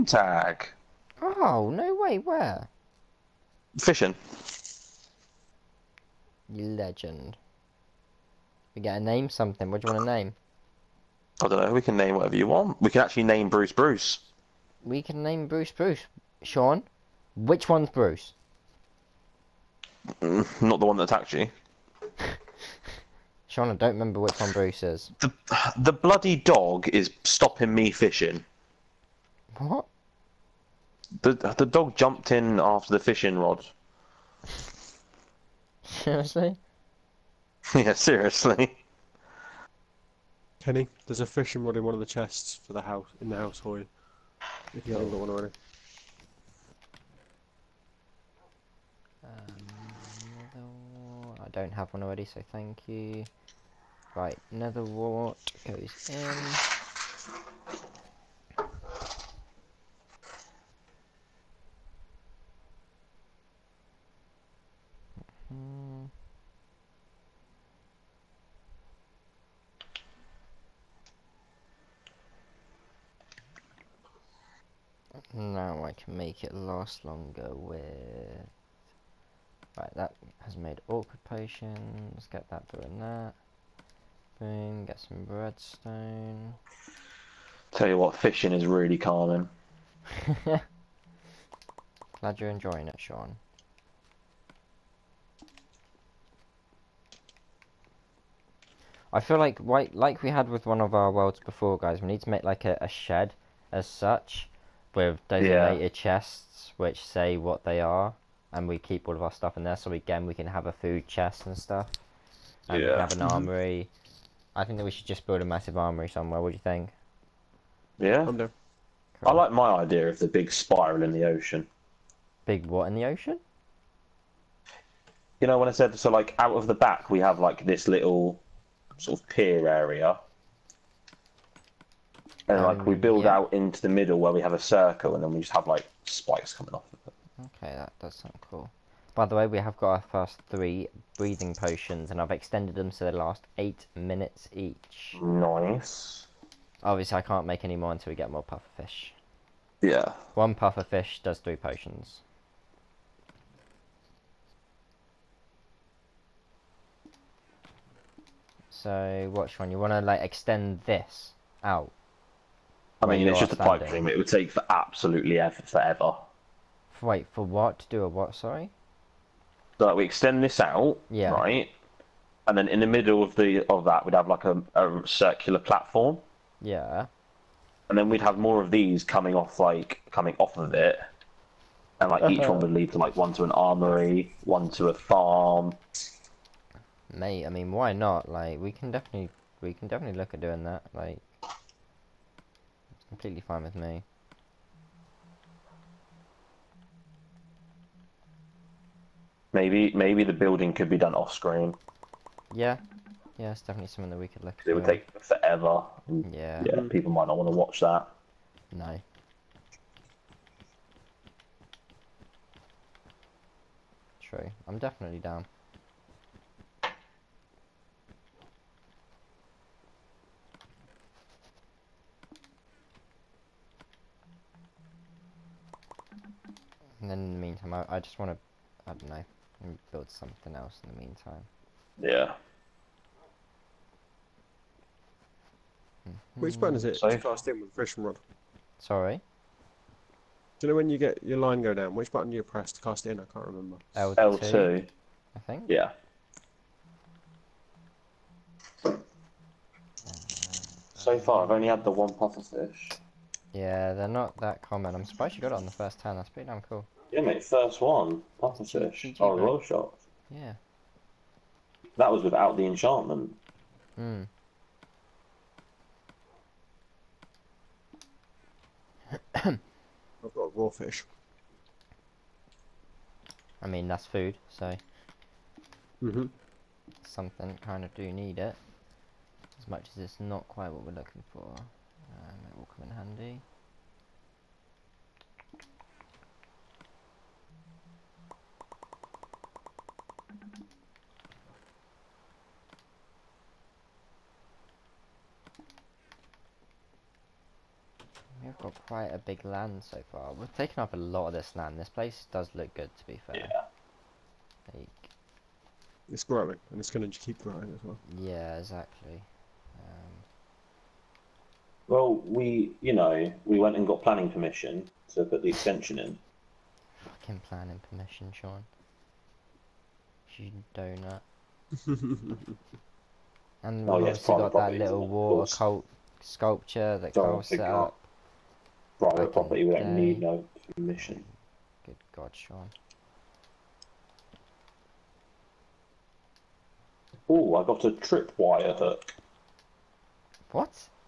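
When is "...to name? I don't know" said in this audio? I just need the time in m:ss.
0:10.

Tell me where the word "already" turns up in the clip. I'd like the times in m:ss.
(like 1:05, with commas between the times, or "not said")
0:45, 0:52.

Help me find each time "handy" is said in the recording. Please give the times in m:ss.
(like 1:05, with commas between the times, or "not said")
4:42.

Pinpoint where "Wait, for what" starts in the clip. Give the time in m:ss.
2:47.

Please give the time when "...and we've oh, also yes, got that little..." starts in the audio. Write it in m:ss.
5:23.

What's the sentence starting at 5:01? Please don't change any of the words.
This place does look good, to be fair.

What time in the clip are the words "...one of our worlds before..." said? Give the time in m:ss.
1:40.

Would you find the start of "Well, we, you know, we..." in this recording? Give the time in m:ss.
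5:11.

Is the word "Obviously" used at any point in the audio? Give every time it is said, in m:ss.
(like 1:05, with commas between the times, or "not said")
2:26.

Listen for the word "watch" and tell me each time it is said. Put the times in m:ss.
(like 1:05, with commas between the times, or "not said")
2:39, 3:27.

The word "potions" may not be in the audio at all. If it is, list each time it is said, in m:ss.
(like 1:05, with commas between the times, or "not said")
1:21, 2:21, 2:31.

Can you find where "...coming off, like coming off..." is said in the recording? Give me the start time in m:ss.
2:59.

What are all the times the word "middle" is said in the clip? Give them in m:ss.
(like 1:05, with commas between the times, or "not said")
2:13, 2:52.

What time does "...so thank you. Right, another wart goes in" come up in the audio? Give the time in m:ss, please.
0:52.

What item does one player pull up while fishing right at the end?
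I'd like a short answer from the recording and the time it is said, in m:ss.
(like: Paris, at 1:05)
tripwire hook, at 5:37.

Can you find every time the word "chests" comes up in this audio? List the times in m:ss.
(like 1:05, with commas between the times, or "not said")
0:42, 1:45, 1:51.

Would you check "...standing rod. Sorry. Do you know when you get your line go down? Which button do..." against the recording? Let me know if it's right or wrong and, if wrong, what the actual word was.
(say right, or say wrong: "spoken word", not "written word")
wrong: "fishing", not "standing".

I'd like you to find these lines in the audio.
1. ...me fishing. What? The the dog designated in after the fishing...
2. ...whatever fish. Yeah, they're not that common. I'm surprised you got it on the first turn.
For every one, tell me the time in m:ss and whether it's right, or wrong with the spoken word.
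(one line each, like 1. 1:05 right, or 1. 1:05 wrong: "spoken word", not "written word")
1. 0:27 wrong: "jumped", not "designated"
2. 4:12 wrong: "puffer", not "whatever".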